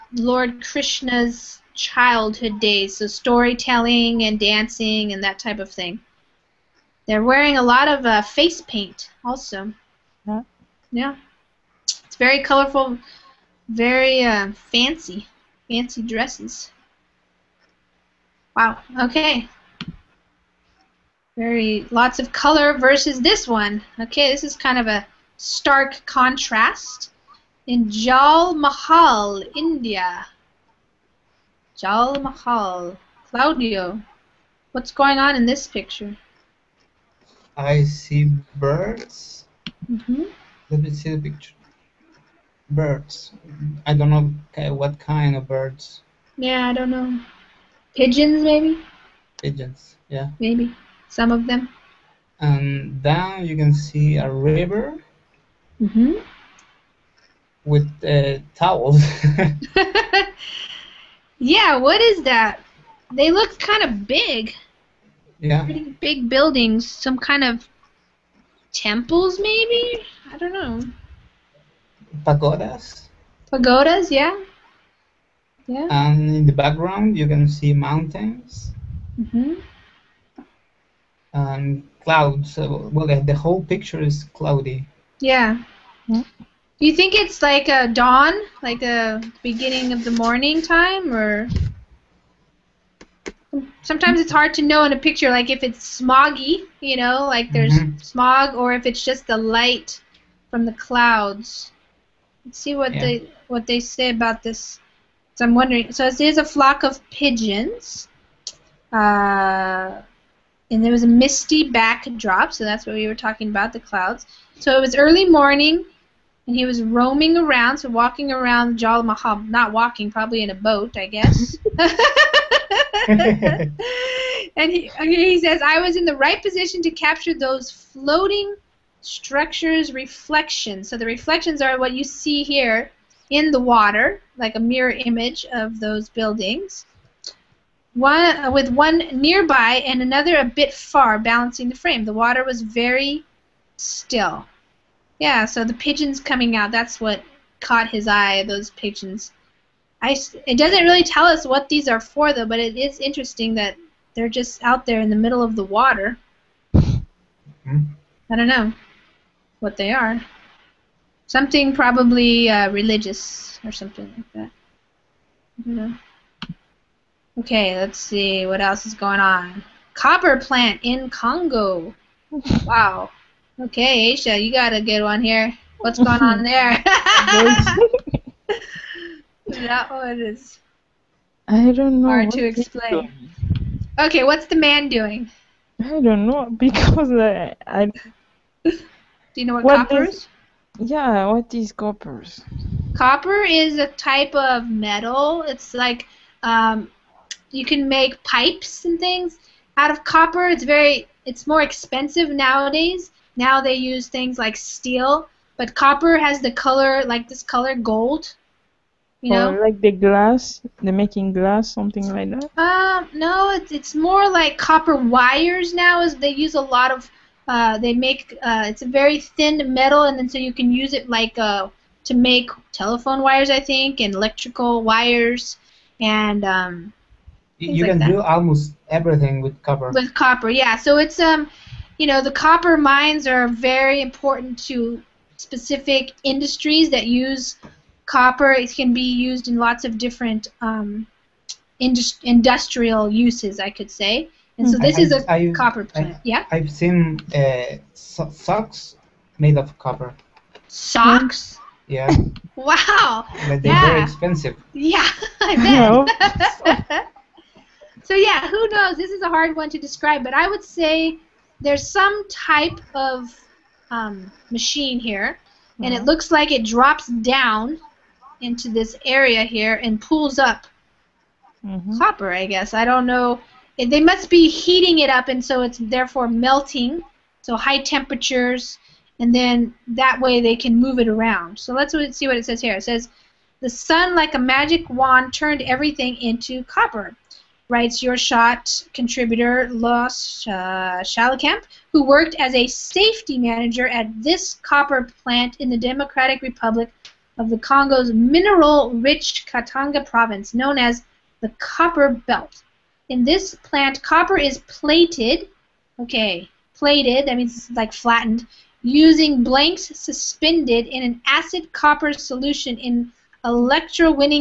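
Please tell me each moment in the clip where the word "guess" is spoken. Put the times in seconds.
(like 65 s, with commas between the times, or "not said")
121 s, 272 s.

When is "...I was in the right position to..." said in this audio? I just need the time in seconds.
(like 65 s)
125 s.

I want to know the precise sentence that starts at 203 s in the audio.
Now they use things like steel, but copper has the color, like this color gold.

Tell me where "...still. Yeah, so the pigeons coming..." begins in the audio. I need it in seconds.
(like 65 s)
143 s.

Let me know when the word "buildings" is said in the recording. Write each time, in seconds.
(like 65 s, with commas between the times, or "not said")
66 s, 136 s.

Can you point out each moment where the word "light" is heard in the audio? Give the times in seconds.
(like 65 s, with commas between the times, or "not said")
99 s.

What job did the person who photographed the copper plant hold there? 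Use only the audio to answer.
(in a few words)
safety manager.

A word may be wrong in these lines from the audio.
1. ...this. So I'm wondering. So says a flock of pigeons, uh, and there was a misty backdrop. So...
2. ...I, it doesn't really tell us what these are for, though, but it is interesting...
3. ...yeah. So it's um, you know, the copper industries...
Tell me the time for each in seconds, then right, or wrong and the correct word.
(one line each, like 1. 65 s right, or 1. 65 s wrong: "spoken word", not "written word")
1. 104 s right
2. 150 s right
3. 230 s wrong: "mines", not "industries".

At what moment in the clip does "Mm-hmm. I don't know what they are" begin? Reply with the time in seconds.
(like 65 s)
156 s.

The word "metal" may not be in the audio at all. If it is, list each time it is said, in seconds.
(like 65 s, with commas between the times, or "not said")
194 s, 219 s.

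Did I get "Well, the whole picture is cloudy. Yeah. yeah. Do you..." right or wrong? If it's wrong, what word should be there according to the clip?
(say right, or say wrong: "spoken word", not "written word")
right.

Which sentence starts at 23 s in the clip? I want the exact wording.
Okay, this is kind of a stark contrast.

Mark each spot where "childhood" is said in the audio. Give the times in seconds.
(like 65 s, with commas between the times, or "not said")
1 s.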